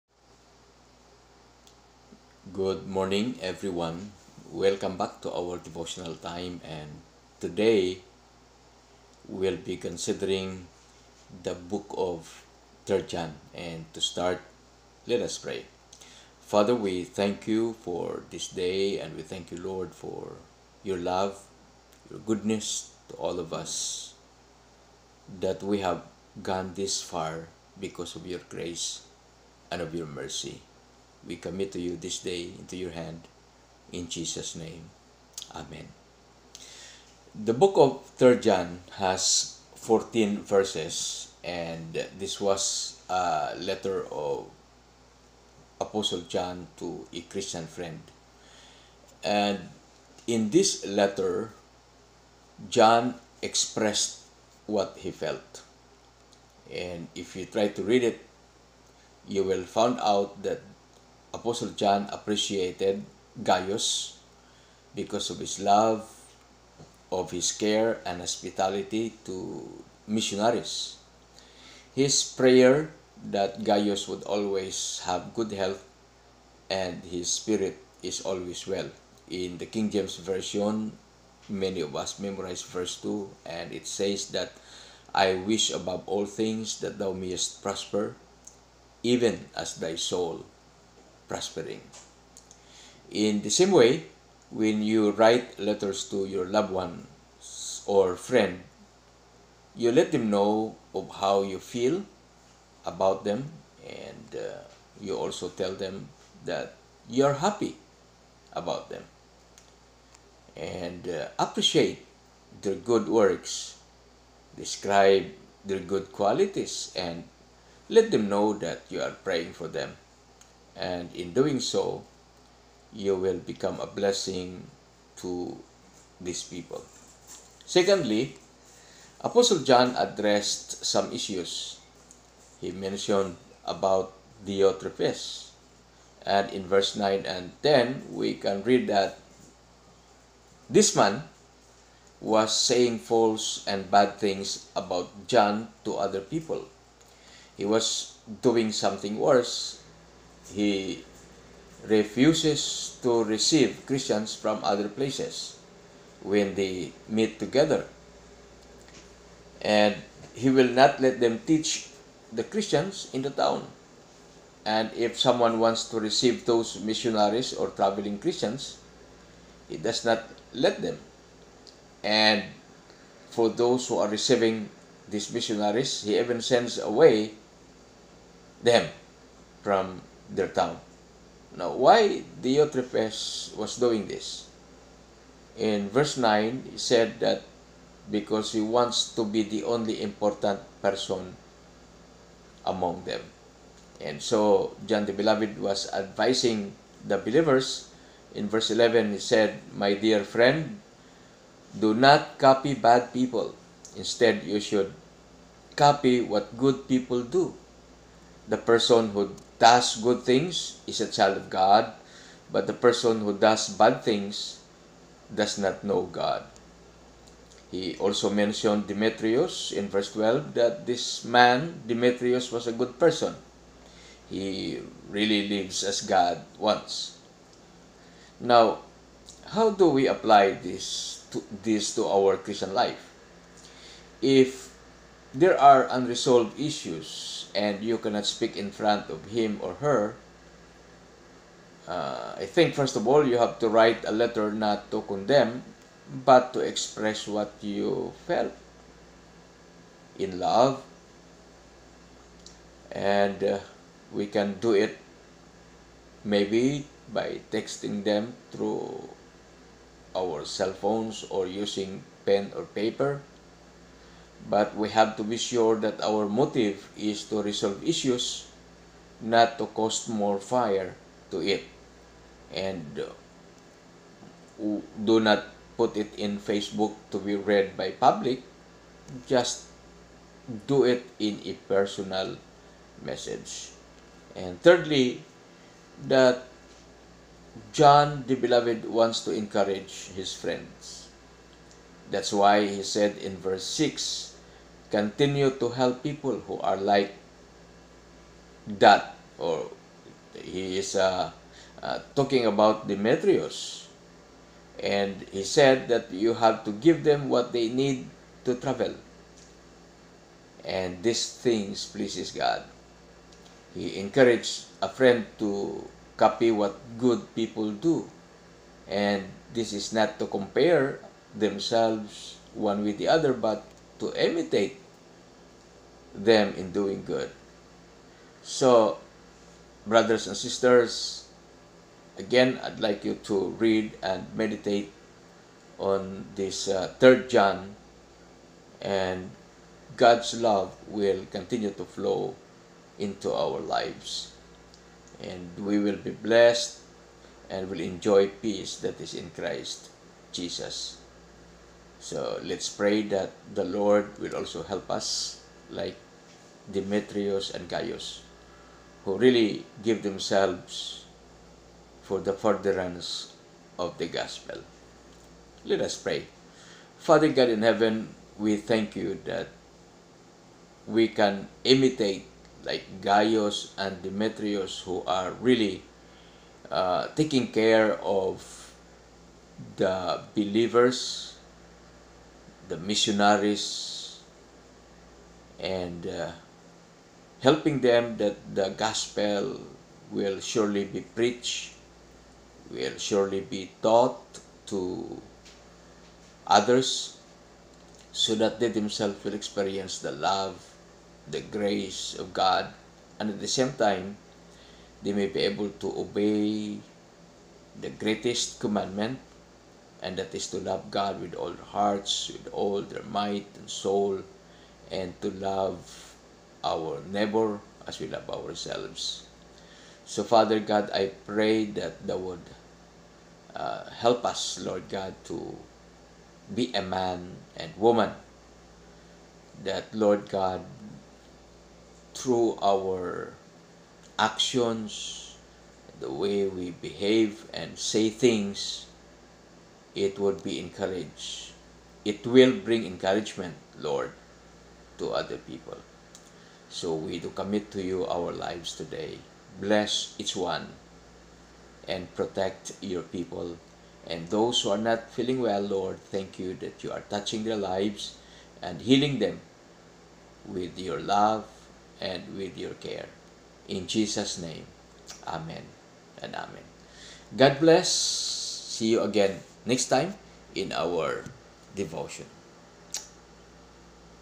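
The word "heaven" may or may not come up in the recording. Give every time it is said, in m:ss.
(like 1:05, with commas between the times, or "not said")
6:07.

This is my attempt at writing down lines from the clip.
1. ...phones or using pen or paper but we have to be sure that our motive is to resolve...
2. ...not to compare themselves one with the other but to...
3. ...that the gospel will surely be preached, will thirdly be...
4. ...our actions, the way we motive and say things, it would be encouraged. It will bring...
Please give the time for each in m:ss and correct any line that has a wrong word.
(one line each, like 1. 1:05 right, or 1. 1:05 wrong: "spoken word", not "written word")
1. 4:20 right
2. 5:19 right
3. 6:28 wrong: "surely", not "thirdly"
4. 7:12 wrong: "behave", not "motive".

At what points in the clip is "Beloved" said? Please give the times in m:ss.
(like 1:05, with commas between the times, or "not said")
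3:15, 4:48.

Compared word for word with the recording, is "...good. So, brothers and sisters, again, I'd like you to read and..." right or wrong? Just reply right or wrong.
right.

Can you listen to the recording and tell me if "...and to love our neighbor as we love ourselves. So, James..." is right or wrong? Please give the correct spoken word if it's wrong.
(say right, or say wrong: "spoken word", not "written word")
wrong: "Father", not "James".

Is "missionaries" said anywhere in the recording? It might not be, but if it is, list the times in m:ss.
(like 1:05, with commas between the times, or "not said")
1:10, 2:46, 2:55, 6:22.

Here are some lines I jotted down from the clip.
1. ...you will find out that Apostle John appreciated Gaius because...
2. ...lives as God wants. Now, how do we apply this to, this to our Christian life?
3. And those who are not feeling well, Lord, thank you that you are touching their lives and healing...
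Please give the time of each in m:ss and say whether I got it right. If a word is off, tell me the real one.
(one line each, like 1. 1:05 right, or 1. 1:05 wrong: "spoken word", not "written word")
1. 0:59 right
2. 3:45 right
3. 7:34 right.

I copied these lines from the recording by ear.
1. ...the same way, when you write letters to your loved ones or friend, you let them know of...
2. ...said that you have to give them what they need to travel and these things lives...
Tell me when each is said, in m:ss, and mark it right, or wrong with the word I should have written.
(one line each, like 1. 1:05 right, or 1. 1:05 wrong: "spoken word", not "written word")
1. 1:33 right
2. 5:05 wrong: "pleases", not "lives".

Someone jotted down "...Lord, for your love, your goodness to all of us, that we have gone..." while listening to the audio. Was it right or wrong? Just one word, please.
right.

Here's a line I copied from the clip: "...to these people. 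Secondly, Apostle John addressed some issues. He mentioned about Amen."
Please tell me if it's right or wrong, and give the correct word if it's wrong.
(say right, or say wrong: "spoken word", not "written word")
wrong: "Diotrephes", not "Amen".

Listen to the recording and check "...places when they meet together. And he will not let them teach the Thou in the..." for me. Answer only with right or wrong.
wrong.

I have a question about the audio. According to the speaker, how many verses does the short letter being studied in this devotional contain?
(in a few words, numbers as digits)
14.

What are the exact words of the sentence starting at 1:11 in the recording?
His prayer that Gaius would always have good health and his spirit is always well.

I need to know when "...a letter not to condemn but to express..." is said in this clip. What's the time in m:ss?
4:04.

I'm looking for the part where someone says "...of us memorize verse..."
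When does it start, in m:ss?
1:21.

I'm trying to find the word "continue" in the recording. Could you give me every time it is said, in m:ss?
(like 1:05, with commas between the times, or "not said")
4:54, 5:41.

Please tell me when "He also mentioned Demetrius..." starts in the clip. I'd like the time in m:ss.
3:37.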